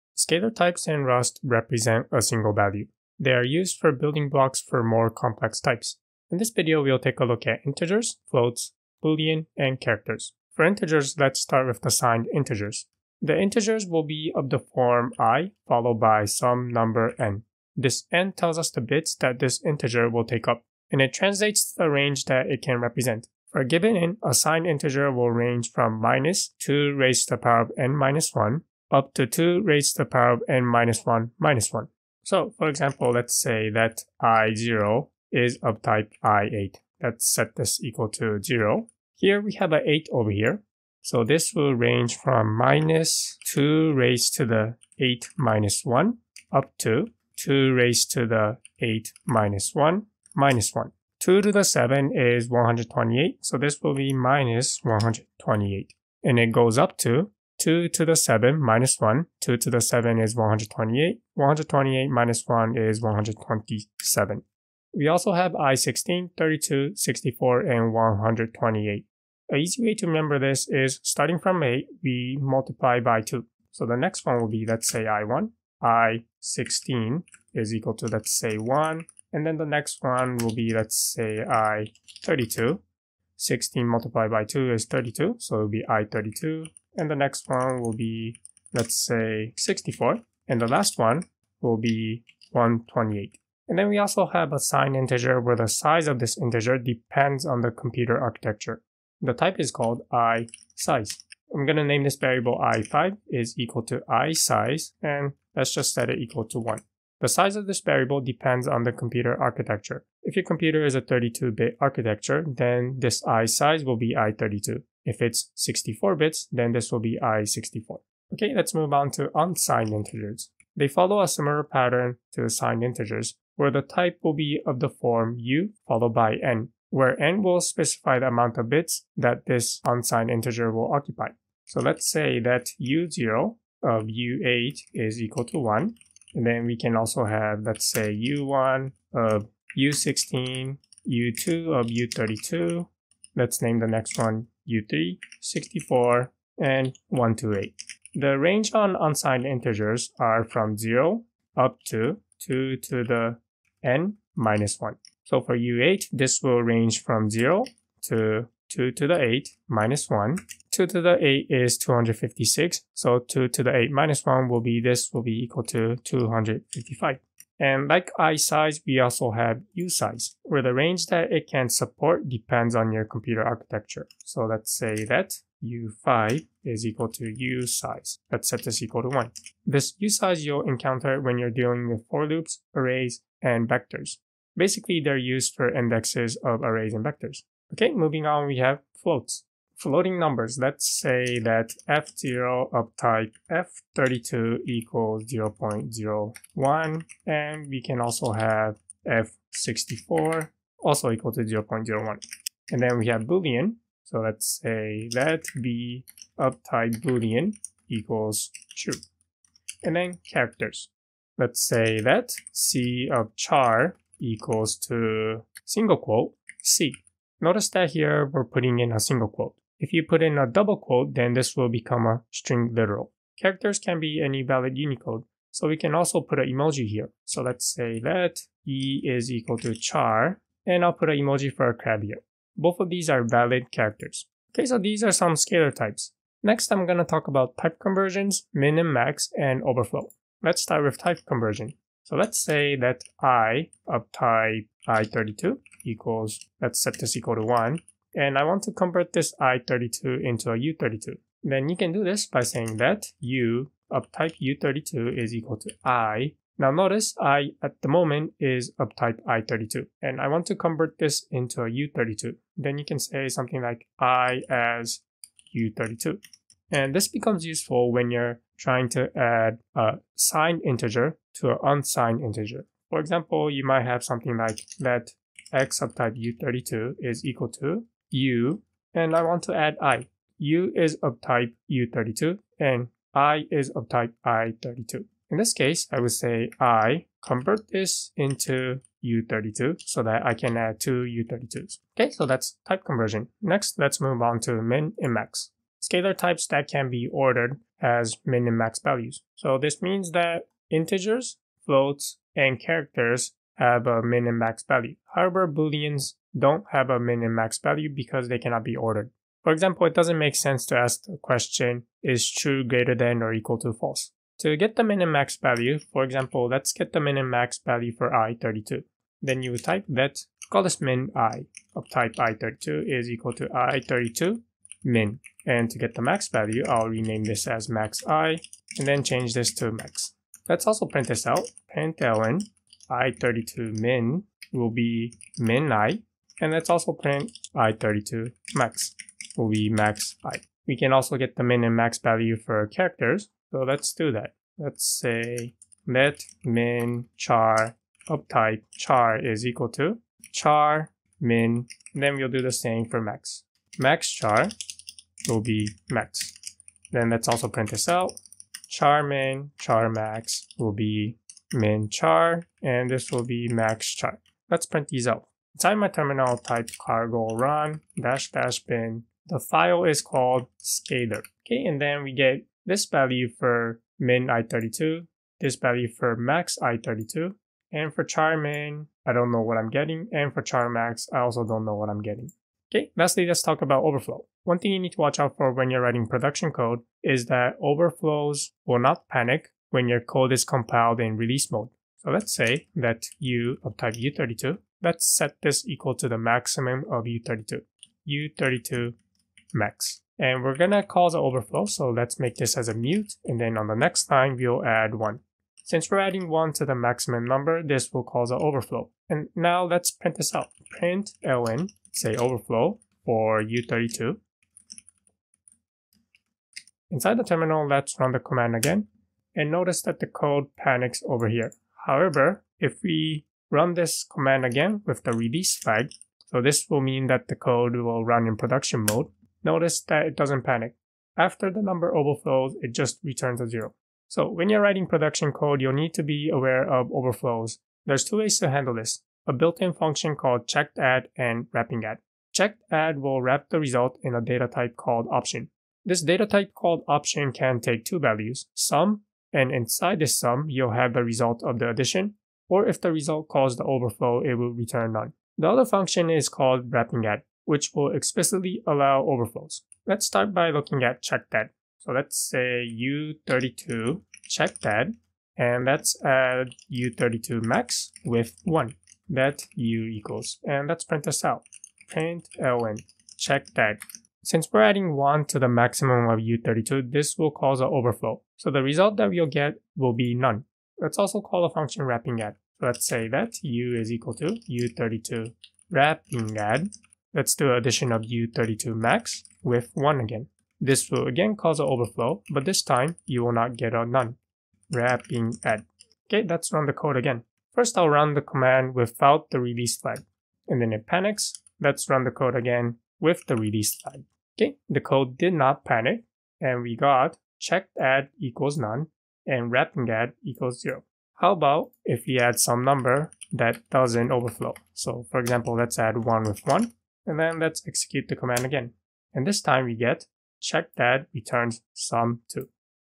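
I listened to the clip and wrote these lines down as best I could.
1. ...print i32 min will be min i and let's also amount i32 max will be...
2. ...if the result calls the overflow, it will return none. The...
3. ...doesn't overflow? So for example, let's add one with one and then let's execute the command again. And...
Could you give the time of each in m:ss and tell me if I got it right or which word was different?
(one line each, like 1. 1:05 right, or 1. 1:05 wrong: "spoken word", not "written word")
1. 5:31 wrong: "print", not "amount"
2. 7:32 right
3. 8:33 right.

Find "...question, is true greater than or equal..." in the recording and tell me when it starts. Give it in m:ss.
5:11.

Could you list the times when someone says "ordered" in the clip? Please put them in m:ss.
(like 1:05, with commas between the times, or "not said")
4:57, 5:08.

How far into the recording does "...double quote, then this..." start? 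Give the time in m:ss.
3:40.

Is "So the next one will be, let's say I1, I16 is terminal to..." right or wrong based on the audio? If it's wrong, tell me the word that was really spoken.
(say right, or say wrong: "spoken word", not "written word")
wrong: "equal", not "terminal".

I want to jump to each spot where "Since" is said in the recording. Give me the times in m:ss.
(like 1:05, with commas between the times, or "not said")
6:45, 7:54.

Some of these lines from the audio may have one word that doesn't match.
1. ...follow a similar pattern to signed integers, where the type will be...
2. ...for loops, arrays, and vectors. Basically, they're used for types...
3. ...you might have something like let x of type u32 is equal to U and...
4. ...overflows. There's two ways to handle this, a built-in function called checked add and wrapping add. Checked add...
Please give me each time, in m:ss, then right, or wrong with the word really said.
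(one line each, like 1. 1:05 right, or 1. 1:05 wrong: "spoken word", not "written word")
1. 2:00 right
2. 3:02 wrong: "indexes", not "types"
3. 4:33 right
4. 7:16 right.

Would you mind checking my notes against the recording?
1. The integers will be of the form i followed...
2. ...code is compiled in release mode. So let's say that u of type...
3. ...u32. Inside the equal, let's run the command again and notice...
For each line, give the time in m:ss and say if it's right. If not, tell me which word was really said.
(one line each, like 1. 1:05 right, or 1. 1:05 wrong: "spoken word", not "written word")
1. 0:13 right
2. 6:30 right
3. 6:53 wrong: "terminal", not "equal".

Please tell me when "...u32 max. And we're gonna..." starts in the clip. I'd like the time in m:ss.
6:38.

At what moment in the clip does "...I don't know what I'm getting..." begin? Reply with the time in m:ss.
6:19.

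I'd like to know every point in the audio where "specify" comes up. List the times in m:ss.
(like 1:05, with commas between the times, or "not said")
2:07.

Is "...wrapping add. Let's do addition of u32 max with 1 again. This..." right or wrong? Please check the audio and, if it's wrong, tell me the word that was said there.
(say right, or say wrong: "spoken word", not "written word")
right.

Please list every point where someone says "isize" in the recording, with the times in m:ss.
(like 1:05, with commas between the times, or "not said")
1:44, 1:53, 2:48.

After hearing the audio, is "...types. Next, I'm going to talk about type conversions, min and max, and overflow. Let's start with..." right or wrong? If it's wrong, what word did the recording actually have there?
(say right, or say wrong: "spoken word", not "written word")
right.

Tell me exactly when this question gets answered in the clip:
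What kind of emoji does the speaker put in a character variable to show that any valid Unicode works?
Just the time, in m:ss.
3:51.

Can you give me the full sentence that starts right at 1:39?
The type is called i size.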